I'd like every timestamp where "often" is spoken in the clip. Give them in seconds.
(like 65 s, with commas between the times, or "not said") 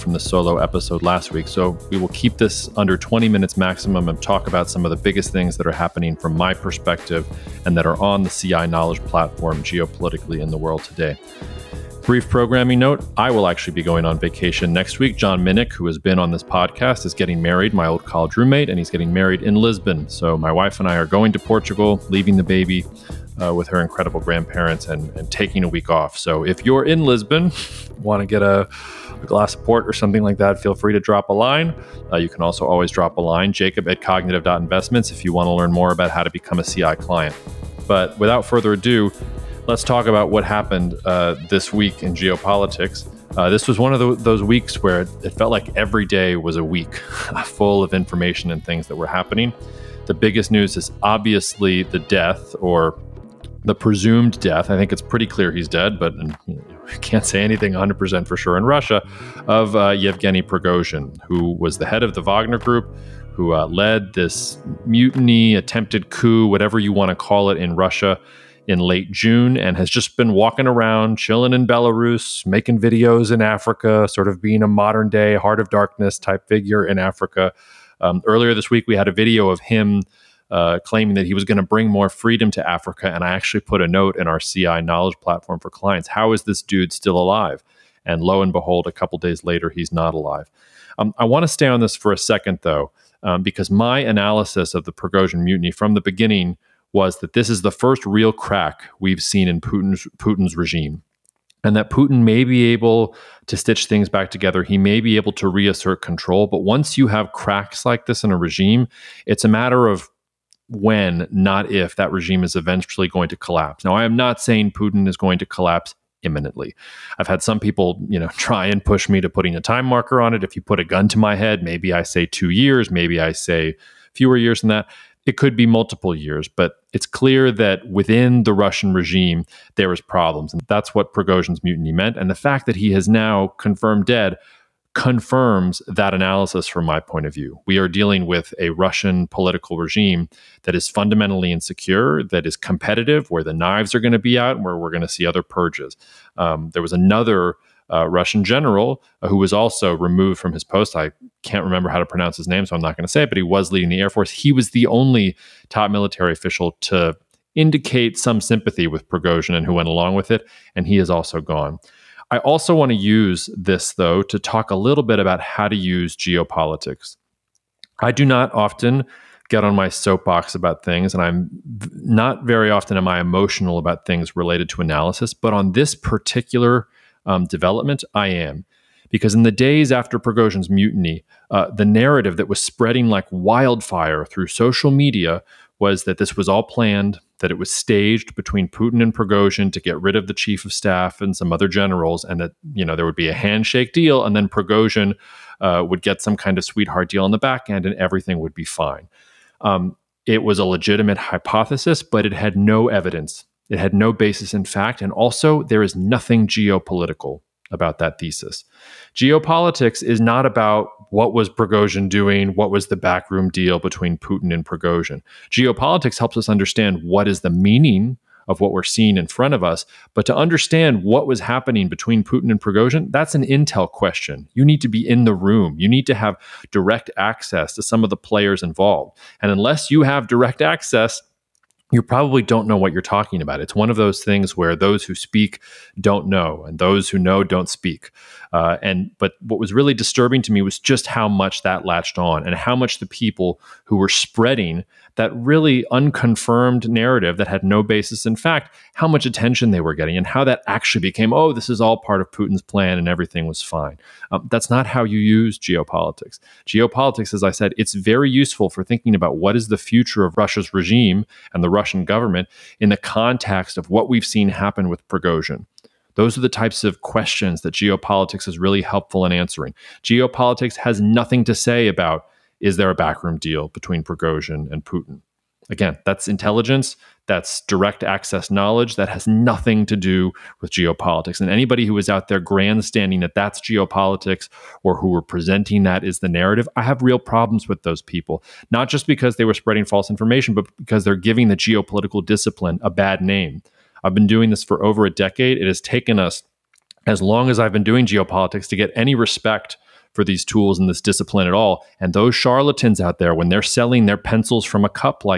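168 s, 172 s.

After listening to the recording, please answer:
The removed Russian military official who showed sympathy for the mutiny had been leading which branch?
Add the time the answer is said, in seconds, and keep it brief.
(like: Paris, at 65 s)
Air Force, at 153 s.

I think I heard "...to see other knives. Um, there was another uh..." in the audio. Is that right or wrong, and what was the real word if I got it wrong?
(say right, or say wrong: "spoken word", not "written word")
wrong: "purges", not "knives".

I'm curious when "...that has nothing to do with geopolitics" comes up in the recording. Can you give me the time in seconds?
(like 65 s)
278 s.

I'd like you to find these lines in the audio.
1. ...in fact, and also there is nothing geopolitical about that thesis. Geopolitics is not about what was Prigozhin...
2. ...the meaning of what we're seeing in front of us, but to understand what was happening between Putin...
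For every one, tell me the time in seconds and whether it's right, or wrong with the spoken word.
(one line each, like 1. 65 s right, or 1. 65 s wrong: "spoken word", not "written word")
1. 204 s right
2. 217 s right.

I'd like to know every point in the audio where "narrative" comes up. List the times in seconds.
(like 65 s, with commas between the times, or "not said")
181 s, 246 s, 286 s.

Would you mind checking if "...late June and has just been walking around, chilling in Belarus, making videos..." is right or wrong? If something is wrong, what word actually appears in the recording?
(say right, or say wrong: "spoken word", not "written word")
right.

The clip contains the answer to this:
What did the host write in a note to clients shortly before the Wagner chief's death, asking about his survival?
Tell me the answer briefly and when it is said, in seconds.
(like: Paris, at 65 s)
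How is this dude still alive?, at 86 s.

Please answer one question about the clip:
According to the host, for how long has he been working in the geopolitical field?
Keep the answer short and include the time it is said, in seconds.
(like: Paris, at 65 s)
over a decade, at 294 s.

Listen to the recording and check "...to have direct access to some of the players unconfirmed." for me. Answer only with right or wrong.
wrong.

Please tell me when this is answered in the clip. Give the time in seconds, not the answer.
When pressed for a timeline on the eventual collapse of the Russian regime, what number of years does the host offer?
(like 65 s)
122 s.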